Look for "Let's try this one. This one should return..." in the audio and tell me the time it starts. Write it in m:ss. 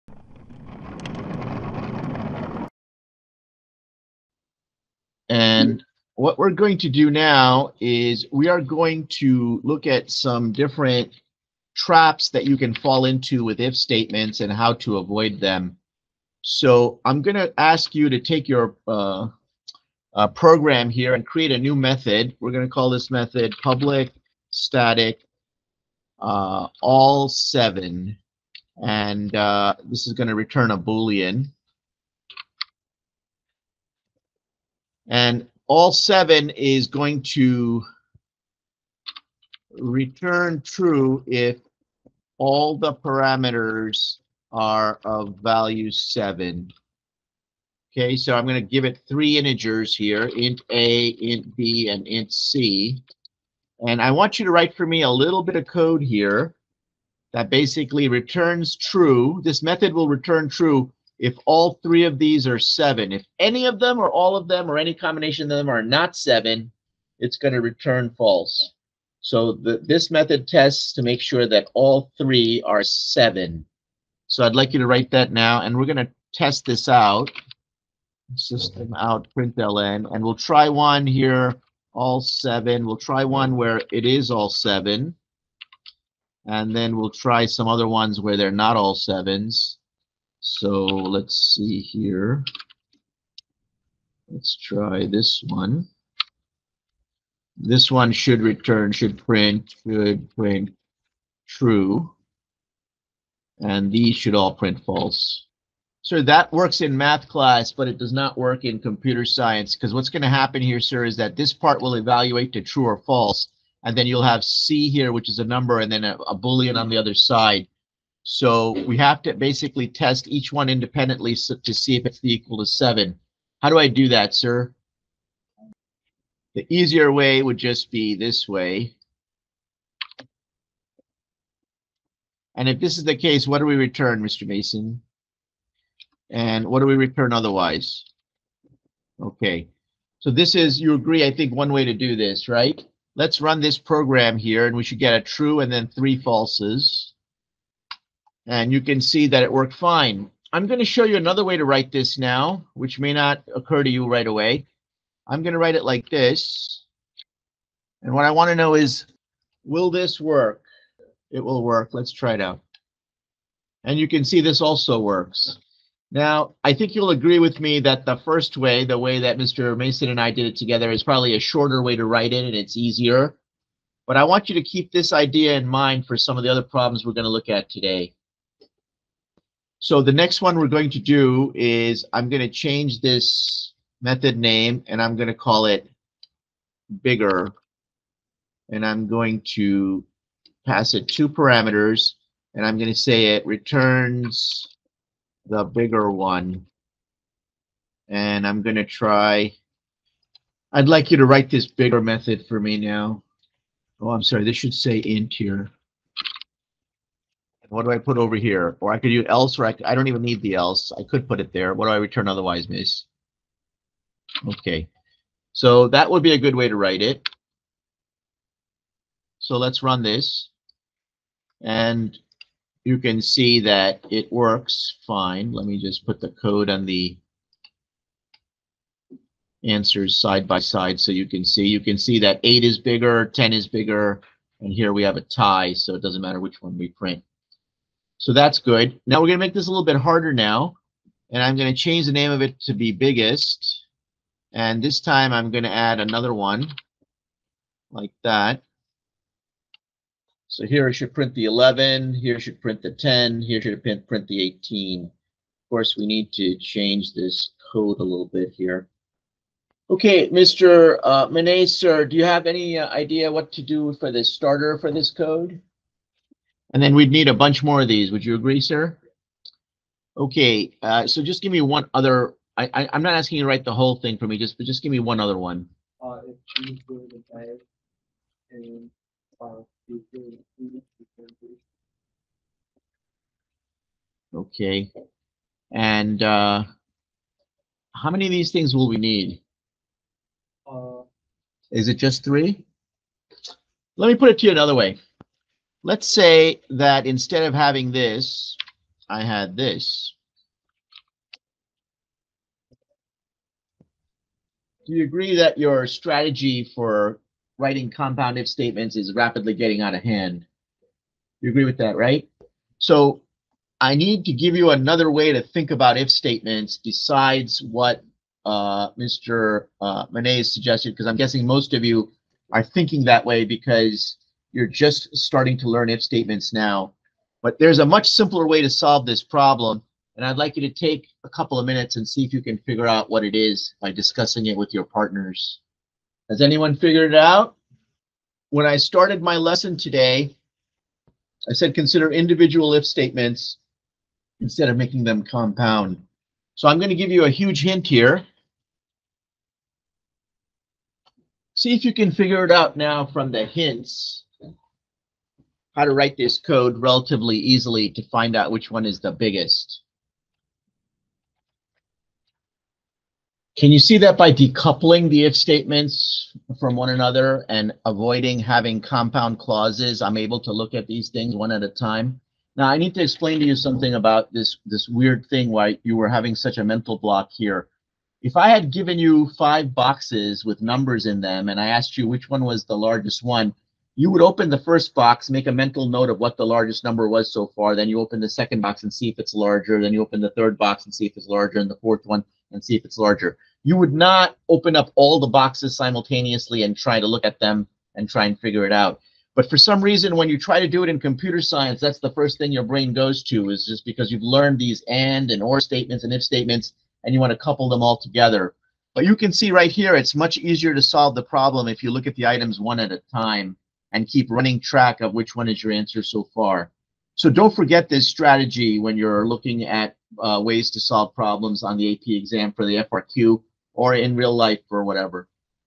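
1:34.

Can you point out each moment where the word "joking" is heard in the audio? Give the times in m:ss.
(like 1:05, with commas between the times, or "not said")
not said.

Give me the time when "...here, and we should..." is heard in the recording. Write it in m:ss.
2:24.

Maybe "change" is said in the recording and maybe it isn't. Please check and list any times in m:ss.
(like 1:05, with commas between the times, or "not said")
3:02, 4:01, 4:16.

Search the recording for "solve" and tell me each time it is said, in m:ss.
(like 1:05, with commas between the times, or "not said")
5:28, 6:50, 7:00.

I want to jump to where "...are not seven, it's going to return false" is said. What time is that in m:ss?
1:05.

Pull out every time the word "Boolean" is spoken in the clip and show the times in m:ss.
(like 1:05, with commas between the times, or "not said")
0:30, 1:56.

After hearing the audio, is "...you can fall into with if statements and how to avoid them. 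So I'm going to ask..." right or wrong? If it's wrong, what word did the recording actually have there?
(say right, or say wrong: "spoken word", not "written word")
right.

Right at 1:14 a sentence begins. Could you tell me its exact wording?
So I'd like you to write that now, and we're going to test this out.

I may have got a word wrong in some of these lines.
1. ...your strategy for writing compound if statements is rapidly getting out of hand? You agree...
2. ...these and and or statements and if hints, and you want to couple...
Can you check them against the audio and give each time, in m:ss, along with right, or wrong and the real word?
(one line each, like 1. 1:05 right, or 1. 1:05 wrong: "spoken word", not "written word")
1. 5:05 right
2. 6:44 wrong: "statements", not "hints".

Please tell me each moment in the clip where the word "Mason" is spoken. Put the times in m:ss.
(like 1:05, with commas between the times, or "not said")
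2:14, 2:49.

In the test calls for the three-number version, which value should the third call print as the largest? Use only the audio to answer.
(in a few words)
18.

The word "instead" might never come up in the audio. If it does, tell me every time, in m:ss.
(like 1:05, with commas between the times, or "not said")
4:57, 5:44.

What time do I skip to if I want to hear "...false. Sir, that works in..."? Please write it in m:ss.
1:44.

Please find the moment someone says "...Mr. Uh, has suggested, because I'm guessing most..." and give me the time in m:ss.
5:18.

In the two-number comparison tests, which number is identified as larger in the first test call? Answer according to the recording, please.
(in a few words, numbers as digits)
8.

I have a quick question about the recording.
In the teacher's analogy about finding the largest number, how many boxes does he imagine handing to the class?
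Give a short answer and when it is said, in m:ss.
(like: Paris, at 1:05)
5, at 6:19.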